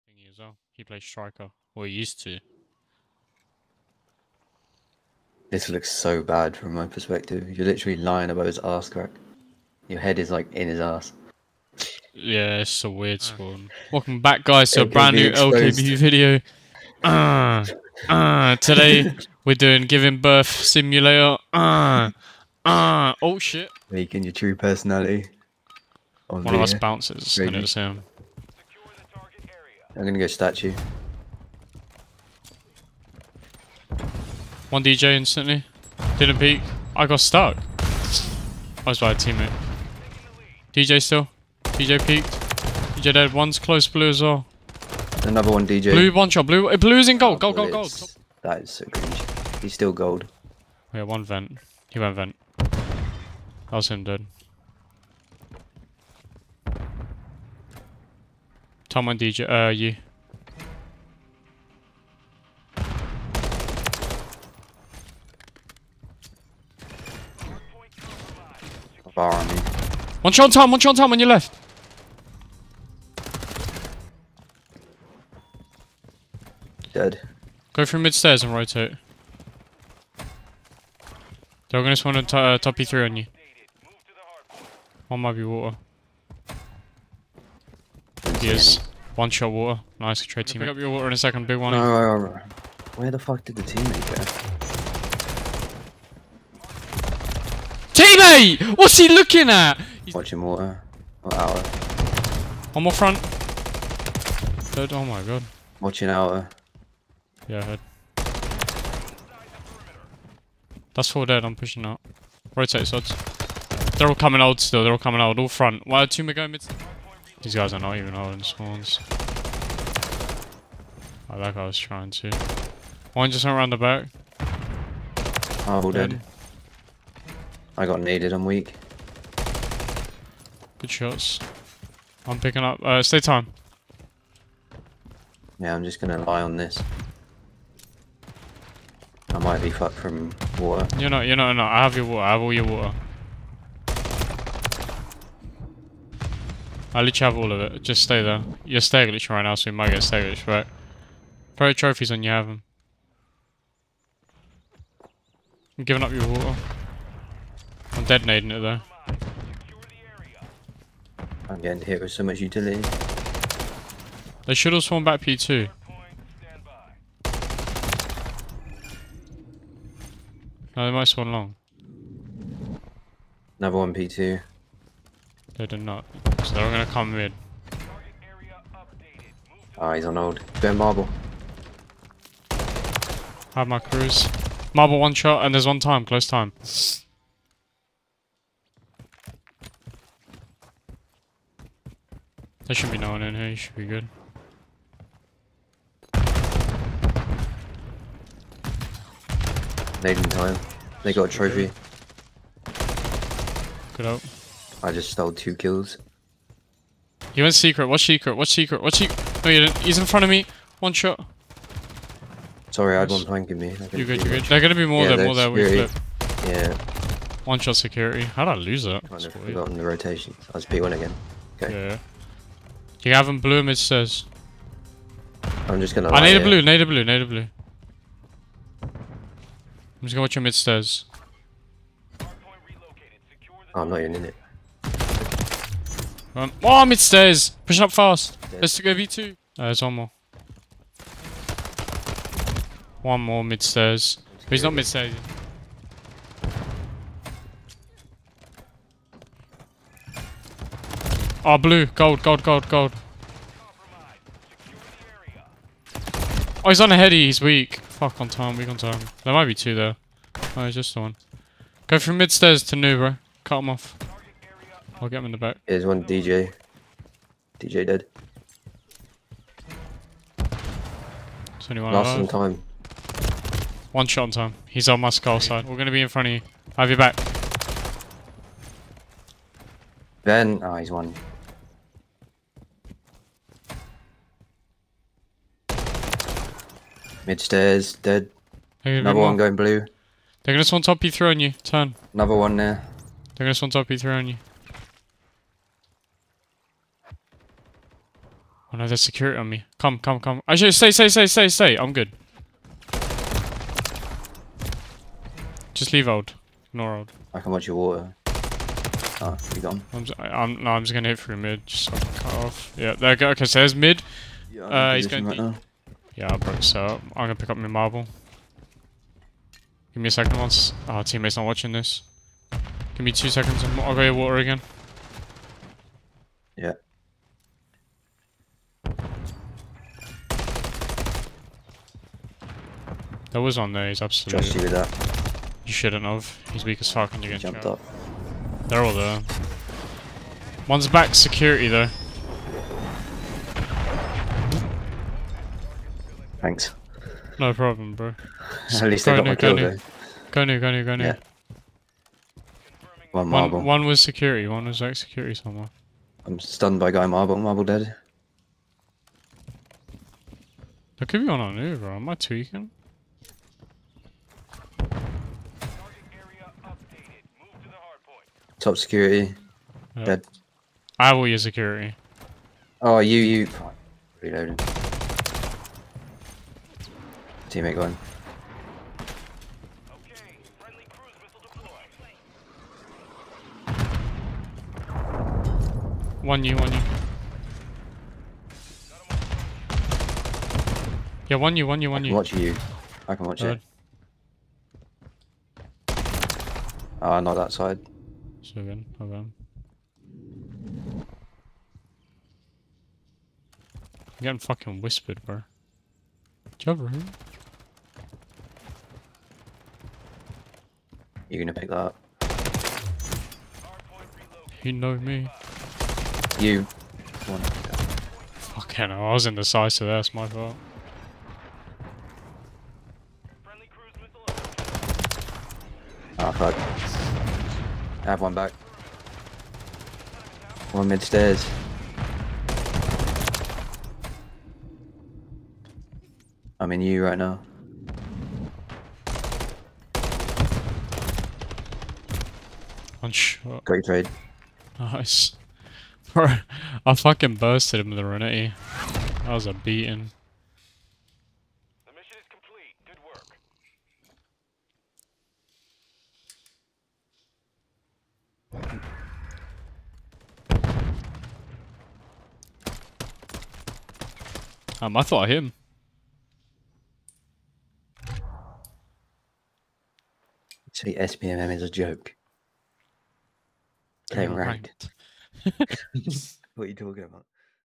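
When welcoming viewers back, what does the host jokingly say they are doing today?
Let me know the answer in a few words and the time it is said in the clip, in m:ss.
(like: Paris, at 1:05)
giving birth simulator, at 0:19.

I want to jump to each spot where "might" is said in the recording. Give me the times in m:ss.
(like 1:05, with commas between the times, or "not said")
1:25, 2:19, 2:29, 2:50, 4:19.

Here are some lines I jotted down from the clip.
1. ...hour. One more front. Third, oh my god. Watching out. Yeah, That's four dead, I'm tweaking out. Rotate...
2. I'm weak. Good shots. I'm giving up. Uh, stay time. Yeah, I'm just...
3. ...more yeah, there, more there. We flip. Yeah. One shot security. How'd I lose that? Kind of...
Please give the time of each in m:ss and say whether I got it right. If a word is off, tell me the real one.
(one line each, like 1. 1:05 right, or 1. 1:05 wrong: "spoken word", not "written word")
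1. 1:41 wrong: "pushing", not "tweaking"
2. 2:08 wrong: "picking", not "giving"
3. 3:34 right.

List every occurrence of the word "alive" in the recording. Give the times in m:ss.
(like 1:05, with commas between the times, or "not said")
4:32.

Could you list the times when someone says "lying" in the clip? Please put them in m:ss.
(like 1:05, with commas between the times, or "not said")
0:07.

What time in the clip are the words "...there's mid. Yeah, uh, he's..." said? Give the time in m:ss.
5:13.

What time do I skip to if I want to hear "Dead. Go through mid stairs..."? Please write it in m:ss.
1:16.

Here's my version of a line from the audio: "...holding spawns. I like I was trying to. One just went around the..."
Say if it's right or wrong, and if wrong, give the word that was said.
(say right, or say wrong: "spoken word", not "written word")
right.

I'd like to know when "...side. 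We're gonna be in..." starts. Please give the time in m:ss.
4:35.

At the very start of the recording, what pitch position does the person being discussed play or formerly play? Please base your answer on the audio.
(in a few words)
striker.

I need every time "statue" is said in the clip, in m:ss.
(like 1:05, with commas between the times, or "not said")
0:30.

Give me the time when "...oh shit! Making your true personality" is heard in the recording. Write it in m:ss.
0:23.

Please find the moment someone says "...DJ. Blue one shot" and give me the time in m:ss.
0:45.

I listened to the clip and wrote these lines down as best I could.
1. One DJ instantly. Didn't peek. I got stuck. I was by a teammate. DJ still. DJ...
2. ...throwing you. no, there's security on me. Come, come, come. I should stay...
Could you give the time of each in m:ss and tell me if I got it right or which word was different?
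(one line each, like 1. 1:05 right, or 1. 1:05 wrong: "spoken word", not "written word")
1. 0:34 right
2. 4:53 right.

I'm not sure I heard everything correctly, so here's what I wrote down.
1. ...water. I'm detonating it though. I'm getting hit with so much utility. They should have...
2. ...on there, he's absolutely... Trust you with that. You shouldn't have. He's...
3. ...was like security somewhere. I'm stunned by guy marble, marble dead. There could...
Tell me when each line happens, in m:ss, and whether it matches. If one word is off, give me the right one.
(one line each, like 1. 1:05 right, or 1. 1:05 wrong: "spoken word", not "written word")
1. 2:36 right
2. 5:33 right
3. 5:54 right.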